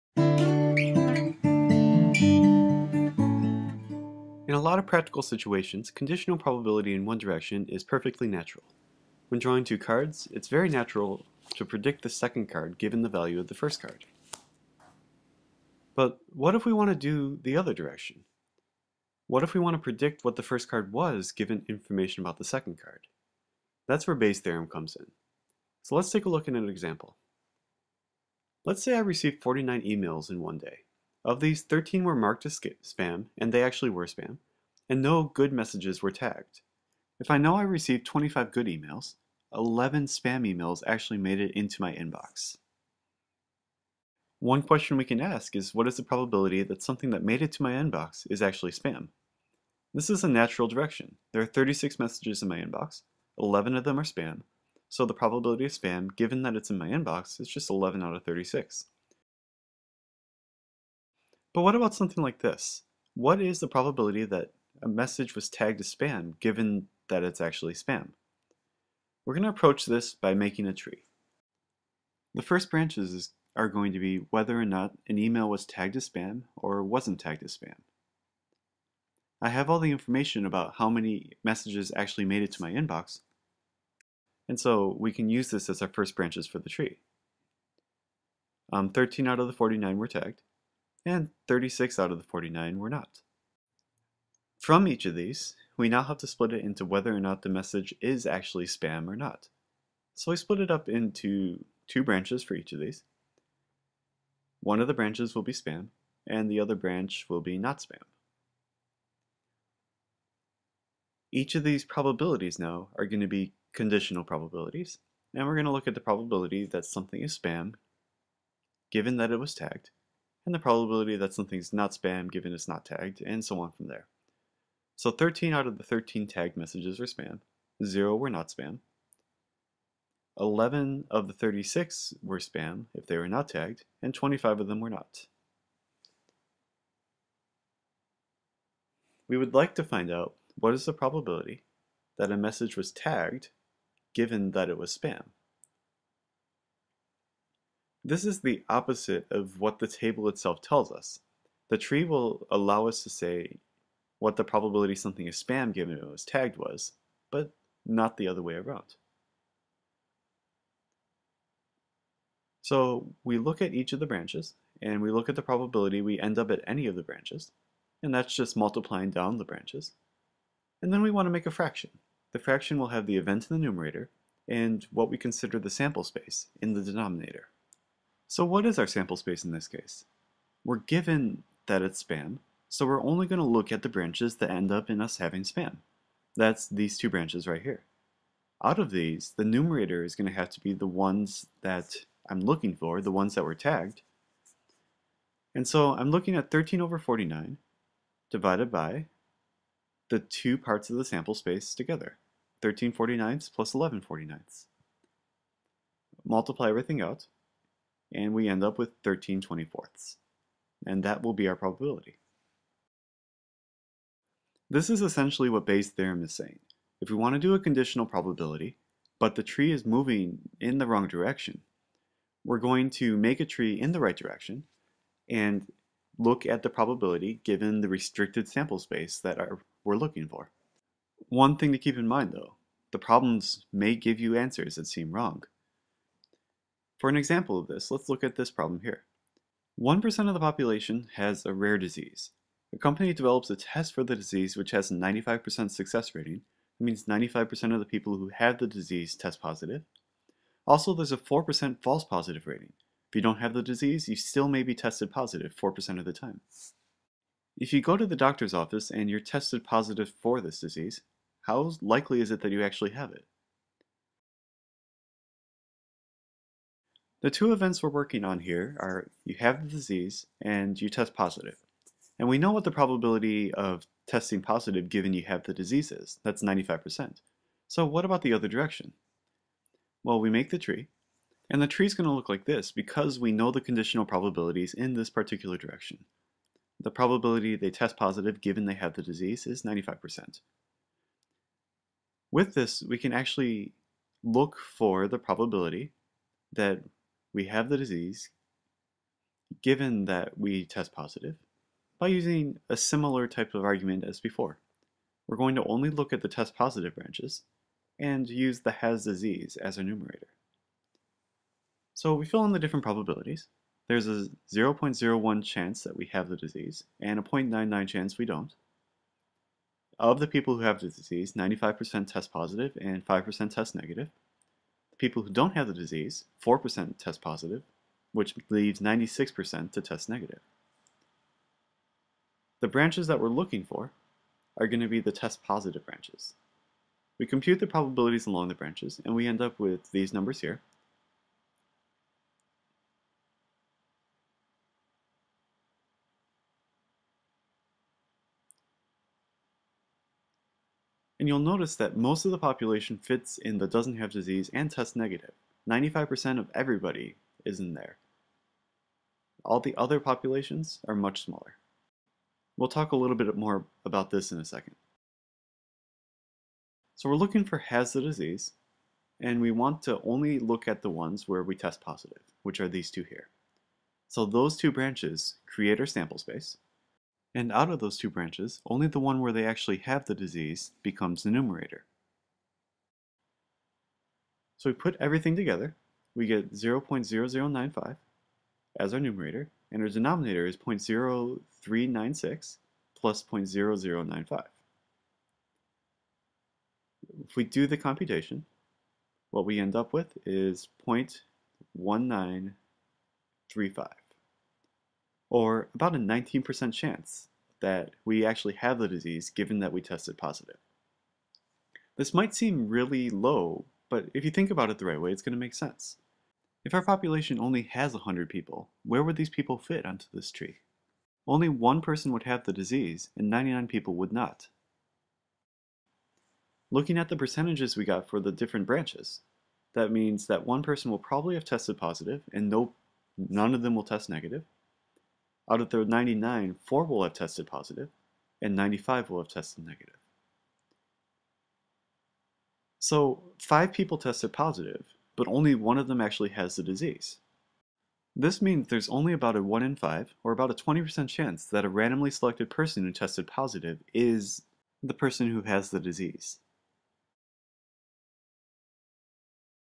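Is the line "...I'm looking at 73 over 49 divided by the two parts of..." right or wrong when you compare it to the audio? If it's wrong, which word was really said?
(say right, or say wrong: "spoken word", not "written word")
wrong: "13", not "73".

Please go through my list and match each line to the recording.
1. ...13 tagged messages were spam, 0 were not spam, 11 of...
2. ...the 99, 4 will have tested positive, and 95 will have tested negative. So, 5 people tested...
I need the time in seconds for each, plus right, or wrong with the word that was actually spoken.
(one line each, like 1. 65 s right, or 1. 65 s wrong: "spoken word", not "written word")
1. 125 s right
2. 435 s right.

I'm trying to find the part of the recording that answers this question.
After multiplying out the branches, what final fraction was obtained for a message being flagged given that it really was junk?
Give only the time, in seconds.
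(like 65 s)
209 s.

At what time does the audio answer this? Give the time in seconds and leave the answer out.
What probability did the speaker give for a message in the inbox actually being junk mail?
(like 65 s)
57 s.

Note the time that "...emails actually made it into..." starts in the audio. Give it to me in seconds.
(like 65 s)
40 s.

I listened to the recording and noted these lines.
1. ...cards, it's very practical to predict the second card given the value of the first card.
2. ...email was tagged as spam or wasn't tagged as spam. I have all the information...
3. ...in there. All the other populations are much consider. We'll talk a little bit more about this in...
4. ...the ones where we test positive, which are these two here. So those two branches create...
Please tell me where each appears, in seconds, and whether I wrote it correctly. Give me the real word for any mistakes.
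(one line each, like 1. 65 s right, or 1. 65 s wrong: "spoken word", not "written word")
1. 9 s wrong: "natural", not "practical"
2. 75 s right
3. 357 s wrong: "smaller", not "consider"
4. 370 s right.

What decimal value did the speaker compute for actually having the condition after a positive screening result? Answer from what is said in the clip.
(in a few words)
0.1935.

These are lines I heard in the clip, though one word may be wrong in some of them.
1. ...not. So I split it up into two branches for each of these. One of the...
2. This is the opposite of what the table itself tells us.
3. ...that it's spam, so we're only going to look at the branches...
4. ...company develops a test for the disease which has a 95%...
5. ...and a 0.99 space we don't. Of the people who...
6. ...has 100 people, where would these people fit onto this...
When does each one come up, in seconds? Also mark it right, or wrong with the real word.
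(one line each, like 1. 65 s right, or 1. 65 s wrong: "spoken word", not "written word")
1. 99 s right
2. 148 s right
3. 181 s right
4. 242 s right
5. 316 s wrong: "chance", not "space"
6. 417 s right.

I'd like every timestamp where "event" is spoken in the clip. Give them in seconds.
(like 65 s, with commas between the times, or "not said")
173 s, 267 s.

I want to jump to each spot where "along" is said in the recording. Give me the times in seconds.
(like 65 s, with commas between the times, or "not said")
338 s.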